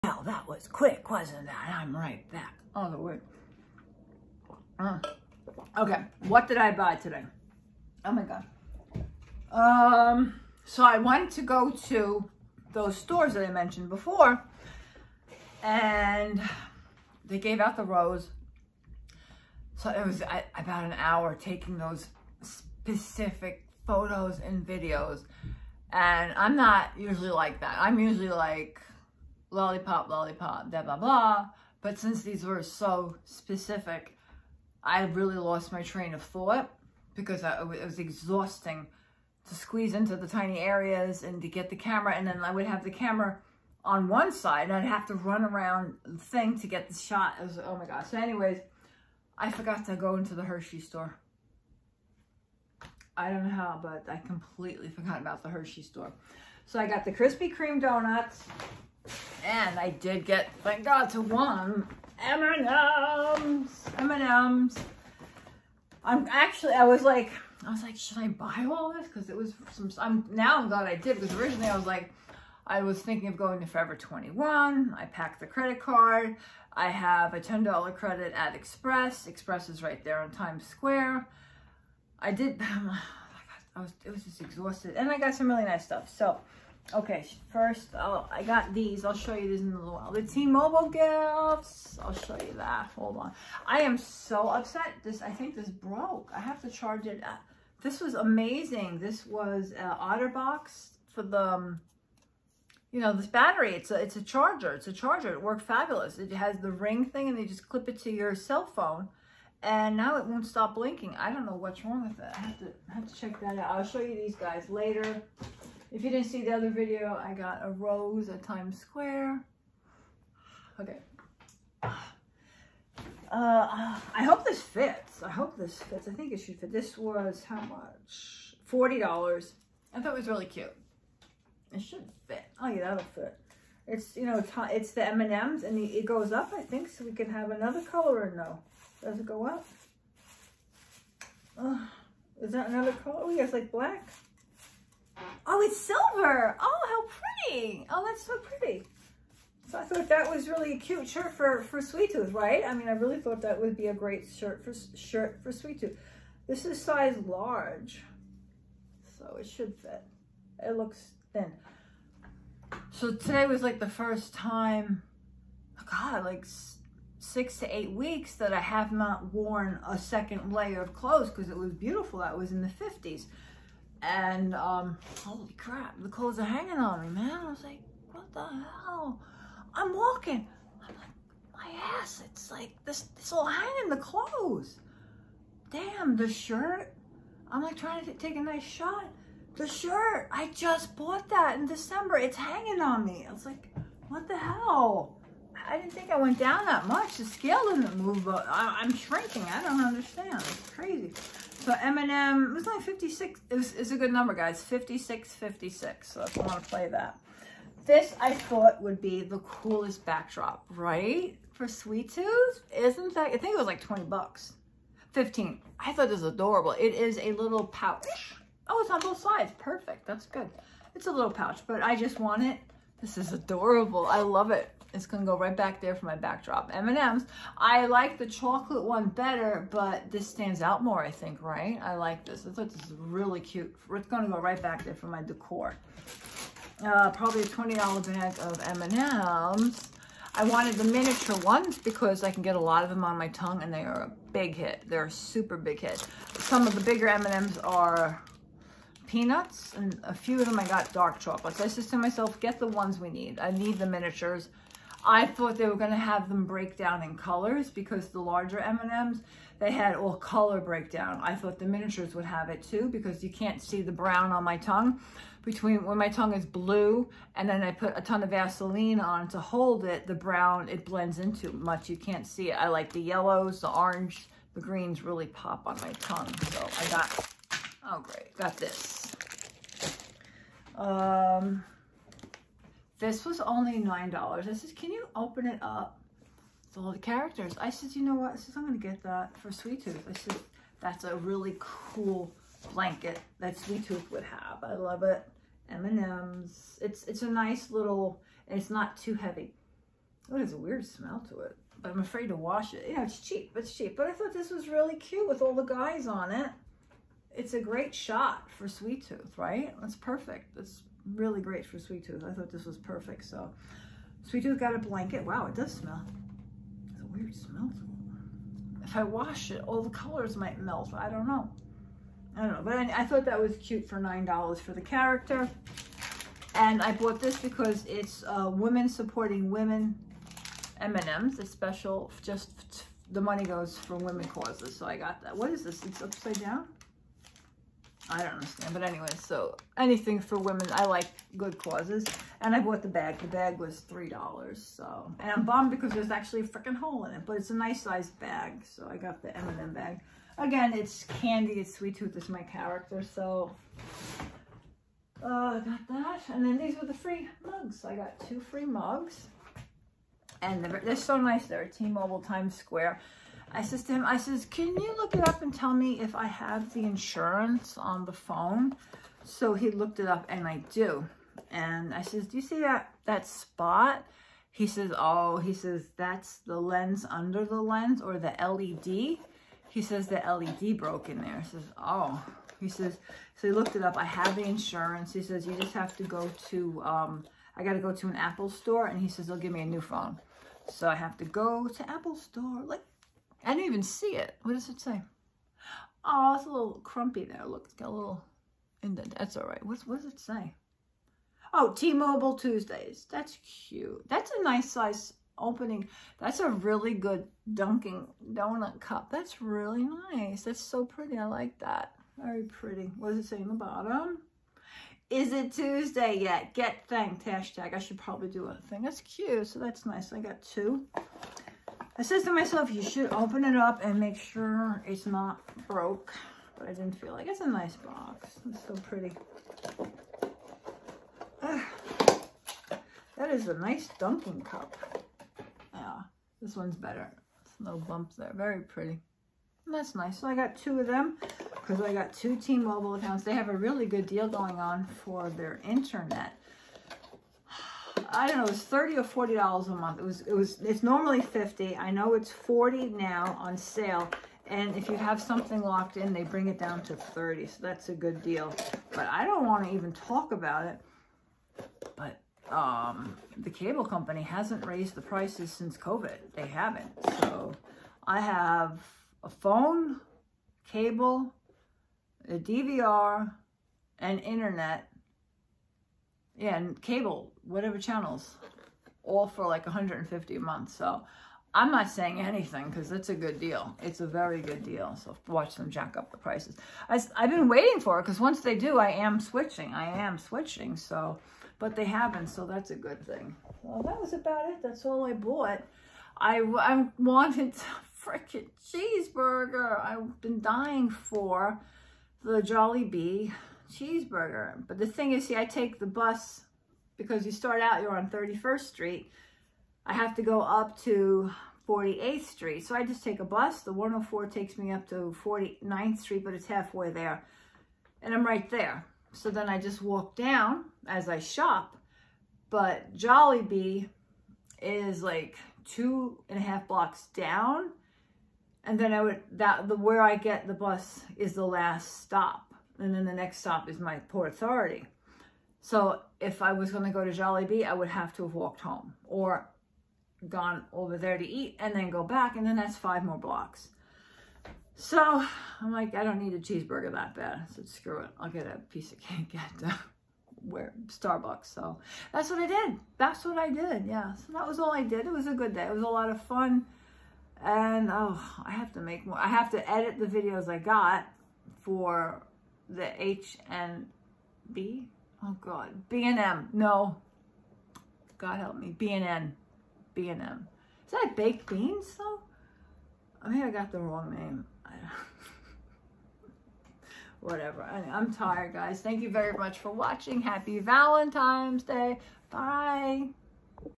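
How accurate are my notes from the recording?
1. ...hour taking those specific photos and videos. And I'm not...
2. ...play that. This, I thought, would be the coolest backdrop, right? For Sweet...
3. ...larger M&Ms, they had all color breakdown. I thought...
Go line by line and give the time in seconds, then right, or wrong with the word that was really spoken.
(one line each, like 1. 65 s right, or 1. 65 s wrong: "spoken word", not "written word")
1. 20 s right
2. 206 s right
3. 258 s right.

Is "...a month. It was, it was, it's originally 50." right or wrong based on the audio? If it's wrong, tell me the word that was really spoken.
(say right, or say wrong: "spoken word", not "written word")
wrong: "normally", not "originally".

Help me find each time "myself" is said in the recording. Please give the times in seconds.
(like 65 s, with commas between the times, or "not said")
251 s, 422 s.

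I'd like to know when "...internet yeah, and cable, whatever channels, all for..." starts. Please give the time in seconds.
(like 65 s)
474 s.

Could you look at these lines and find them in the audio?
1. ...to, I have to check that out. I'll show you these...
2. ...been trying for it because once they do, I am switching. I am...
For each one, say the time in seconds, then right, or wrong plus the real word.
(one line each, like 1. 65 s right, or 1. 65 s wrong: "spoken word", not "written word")
1. 112 s right
2. 487 s wrong: "waiting", not "trying".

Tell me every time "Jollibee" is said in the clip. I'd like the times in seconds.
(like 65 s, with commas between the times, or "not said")
502 s, 522 s, 537 s.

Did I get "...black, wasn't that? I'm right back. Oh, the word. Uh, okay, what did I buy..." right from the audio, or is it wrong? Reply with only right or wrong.
wrong.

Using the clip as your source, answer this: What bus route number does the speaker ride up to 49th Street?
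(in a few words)
104.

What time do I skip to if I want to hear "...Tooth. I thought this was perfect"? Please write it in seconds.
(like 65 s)
312 s.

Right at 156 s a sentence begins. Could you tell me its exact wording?
This is size large, so it should fit.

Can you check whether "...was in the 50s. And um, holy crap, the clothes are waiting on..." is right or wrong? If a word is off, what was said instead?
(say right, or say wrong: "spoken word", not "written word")
wrong: "hanging", not "waiting".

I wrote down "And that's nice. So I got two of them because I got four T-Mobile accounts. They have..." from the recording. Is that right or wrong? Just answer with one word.
wrong.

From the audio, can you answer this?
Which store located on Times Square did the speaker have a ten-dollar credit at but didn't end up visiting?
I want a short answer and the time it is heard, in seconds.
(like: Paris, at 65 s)
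Express, at 76 s.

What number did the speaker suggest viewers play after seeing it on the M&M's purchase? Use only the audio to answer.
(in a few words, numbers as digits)
56.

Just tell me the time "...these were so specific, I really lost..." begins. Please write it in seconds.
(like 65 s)
32 s.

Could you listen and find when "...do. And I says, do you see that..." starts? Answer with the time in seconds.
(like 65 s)
370 s.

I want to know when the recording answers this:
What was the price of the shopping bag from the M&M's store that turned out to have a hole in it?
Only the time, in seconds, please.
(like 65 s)
343 s.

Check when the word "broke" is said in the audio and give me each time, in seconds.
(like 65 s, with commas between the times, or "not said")
95 s, 380 s, 425 s.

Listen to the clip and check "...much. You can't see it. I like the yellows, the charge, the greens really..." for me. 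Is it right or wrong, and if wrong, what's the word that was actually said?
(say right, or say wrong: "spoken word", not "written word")
wrong: "orange", not "charge".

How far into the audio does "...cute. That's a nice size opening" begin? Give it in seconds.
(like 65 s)
403 s.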